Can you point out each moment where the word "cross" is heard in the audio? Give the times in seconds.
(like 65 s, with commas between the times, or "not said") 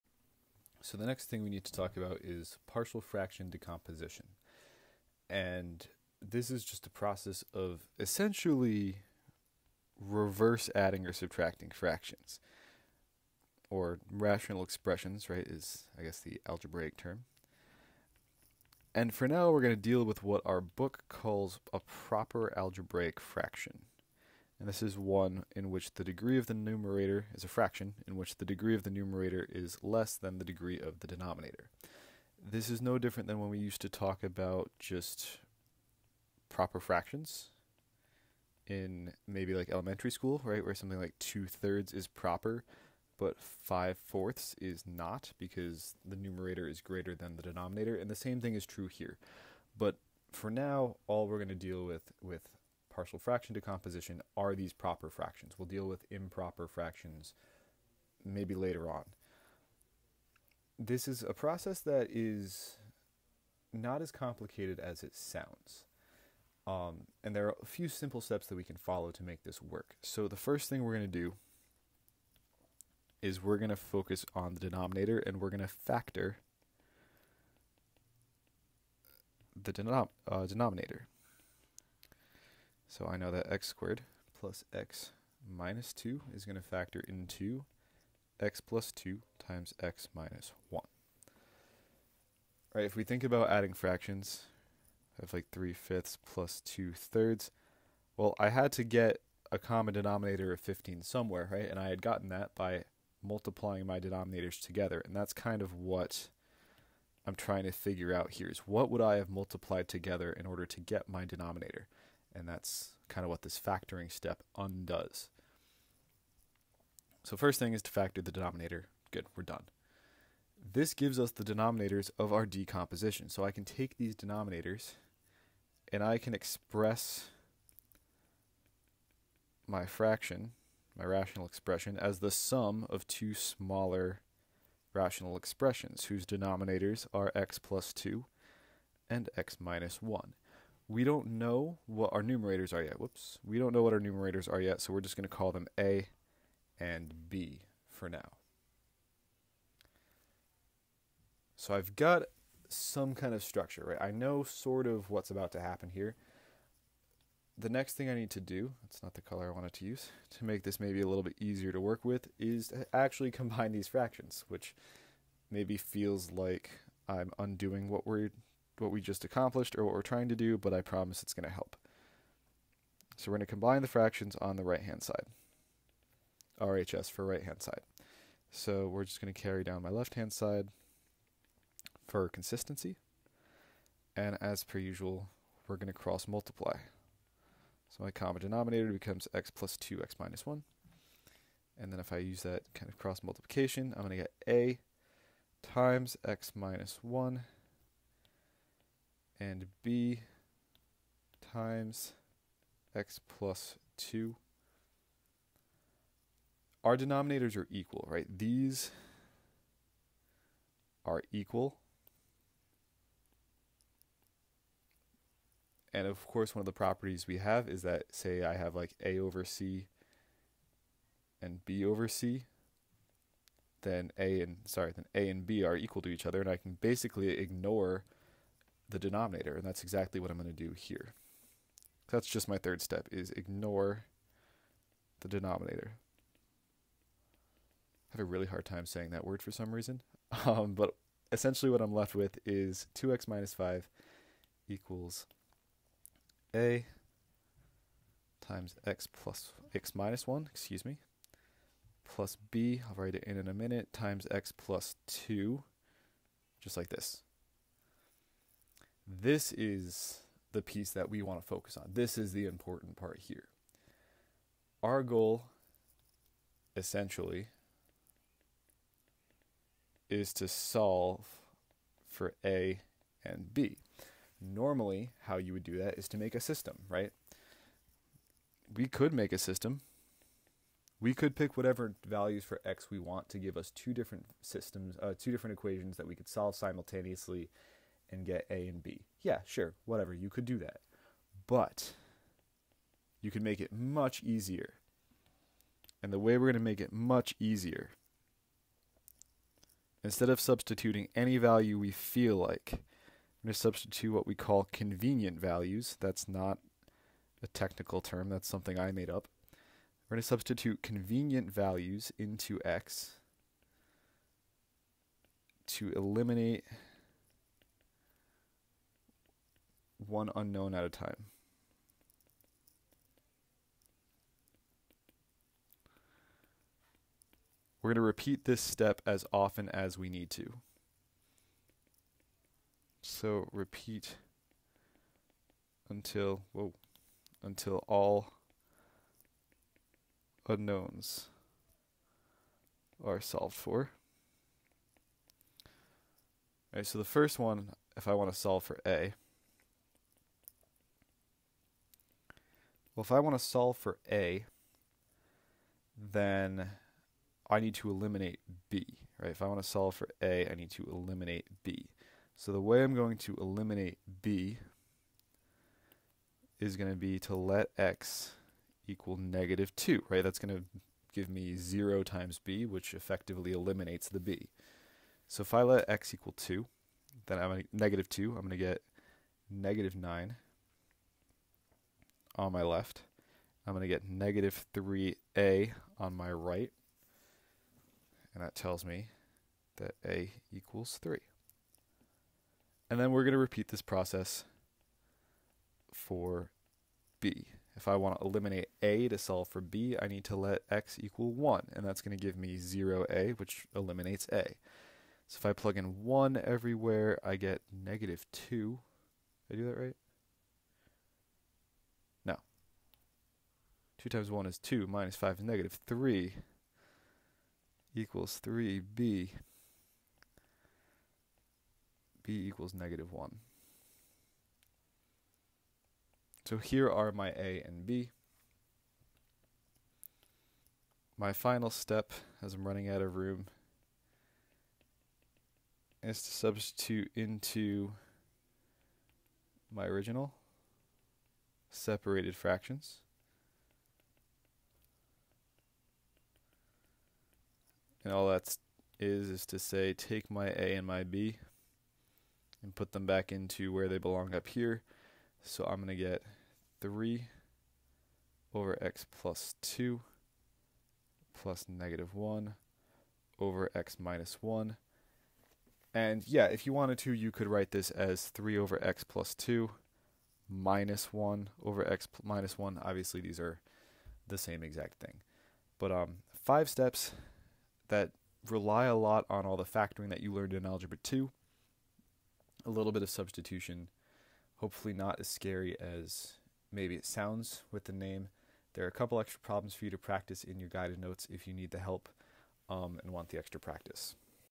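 185 s, 192 s.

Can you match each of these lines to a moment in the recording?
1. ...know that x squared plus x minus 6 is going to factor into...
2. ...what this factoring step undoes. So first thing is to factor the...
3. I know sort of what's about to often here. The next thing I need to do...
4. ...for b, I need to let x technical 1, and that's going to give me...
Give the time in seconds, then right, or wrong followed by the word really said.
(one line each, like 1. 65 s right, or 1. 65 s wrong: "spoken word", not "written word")
1. 83 s wrong: "2", not "6"
2. 113 s right
3. 154 s wrong: "happen", not "often"
4. 399 s wrong: "equal", not "technical".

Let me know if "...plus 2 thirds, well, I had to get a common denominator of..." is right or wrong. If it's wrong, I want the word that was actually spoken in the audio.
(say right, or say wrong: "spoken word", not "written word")
right.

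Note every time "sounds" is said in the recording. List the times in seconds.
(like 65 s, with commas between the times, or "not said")
65 s, 487 s.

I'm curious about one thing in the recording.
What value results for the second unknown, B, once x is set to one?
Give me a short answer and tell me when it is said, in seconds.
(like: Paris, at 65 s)
-1, at 418 s.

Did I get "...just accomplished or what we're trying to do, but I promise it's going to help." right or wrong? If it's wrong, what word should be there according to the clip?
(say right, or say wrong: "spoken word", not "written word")
right.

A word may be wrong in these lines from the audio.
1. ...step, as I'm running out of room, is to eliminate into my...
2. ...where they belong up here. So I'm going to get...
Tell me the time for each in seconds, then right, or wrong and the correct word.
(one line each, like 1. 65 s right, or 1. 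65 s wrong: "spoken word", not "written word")
1. 431 s wrong: "substitute", not "eliminate"
2. 453 s right.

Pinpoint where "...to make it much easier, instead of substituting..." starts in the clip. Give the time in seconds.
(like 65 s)
296 s.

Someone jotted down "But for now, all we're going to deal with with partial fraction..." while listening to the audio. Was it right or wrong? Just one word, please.
right.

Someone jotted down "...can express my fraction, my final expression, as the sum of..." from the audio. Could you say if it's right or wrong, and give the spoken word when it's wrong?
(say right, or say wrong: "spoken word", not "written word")
wrong: "rational", not "final".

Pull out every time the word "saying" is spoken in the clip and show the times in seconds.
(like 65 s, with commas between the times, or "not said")
238 s.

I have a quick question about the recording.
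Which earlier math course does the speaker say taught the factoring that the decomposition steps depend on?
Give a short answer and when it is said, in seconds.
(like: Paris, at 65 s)
Algebra 2, at 480 s.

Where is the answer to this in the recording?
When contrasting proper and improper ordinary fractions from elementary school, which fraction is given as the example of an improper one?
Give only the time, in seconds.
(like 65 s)
43 s.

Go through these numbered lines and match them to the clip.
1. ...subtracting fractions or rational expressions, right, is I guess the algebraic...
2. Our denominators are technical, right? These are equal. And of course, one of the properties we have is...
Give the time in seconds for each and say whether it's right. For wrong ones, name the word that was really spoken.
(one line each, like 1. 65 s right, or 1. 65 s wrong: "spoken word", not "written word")
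1. 11 s right
2. 206 s wrong: "equal", not "technical".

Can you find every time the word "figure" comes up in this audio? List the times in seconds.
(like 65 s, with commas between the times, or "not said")
107 s.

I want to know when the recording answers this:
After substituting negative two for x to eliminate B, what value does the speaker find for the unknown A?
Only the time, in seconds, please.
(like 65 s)
390 s.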